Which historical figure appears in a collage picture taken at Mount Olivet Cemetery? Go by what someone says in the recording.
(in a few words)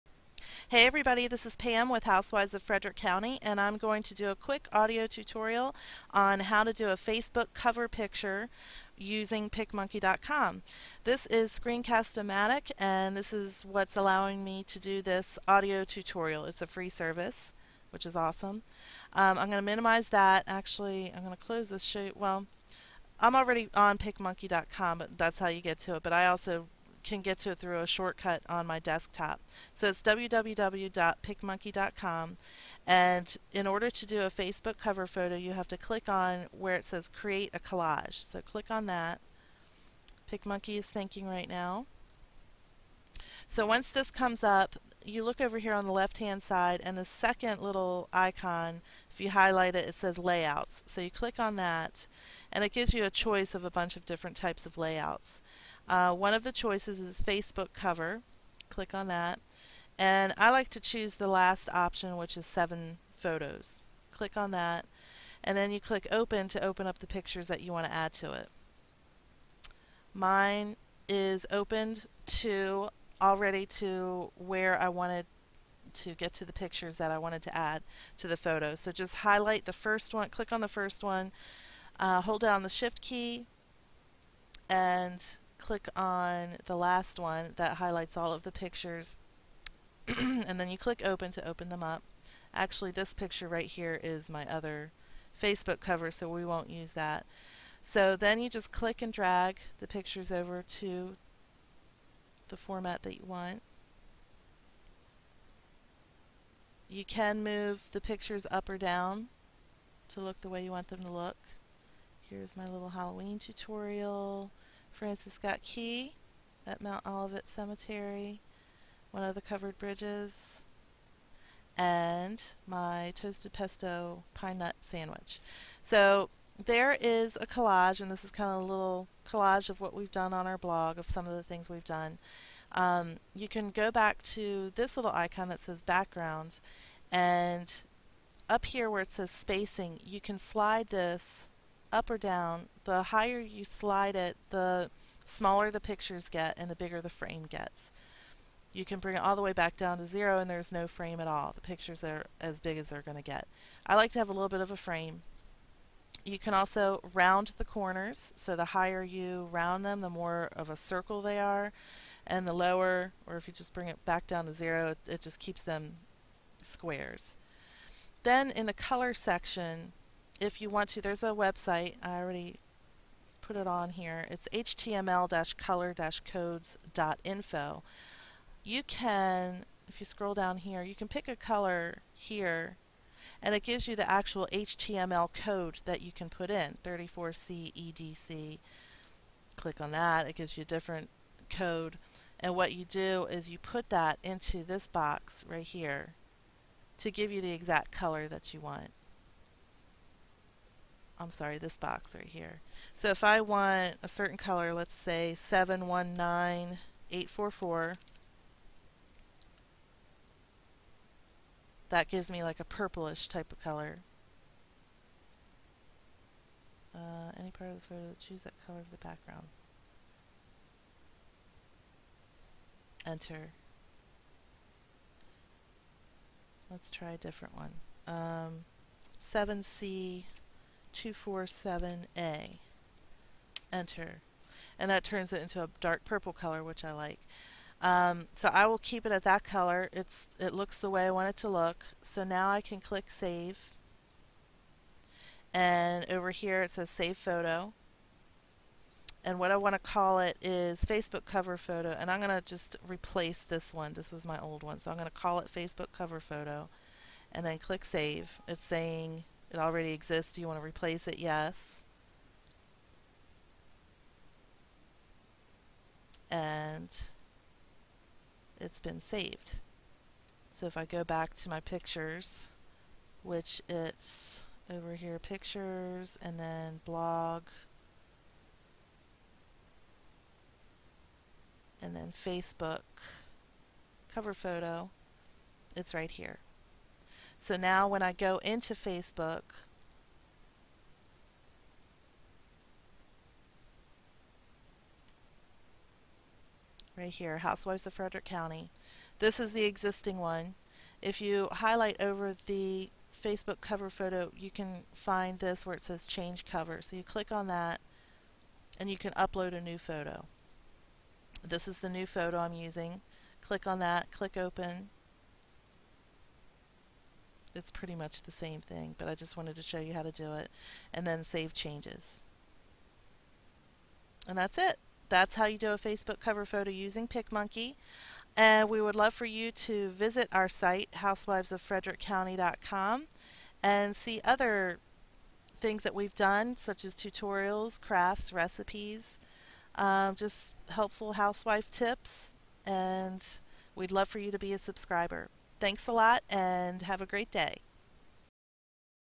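Francis Scott Key.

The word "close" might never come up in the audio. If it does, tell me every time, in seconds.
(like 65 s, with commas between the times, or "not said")
21 s.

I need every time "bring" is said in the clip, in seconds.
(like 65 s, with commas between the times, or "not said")
148 s, 163 s.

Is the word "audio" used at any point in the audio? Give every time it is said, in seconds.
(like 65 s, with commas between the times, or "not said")
4 s, 15 s.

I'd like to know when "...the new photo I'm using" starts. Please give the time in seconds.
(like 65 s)
311 s.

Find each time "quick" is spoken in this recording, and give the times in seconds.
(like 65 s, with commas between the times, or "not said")
4 s.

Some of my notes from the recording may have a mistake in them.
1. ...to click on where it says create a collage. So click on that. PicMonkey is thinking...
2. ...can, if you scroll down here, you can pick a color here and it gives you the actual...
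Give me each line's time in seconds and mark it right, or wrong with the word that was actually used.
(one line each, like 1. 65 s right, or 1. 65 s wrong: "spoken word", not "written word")
1. 35 s right
2. 178 s right.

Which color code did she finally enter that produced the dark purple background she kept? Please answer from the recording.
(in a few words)
7C247A.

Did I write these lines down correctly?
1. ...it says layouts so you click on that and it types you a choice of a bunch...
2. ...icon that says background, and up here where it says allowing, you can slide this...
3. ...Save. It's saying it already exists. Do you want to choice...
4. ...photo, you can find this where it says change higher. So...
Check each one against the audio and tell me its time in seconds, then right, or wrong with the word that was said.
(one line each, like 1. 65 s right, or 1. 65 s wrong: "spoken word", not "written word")
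1. 49 s wrong: "gives", not "types"
2. 135 s wrong: "spacing", not "allowing"
3. 257 s wrong: "replace", not "choice"
4. 303 s wrong: "cover", not "higher".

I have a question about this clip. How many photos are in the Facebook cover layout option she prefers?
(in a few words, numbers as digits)
7.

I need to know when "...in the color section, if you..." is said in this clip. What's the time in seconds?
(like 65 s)
168 s.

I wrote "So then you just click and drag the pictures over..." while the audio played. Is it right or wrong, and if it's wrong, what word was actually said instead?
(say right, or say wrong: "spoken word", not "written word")
right.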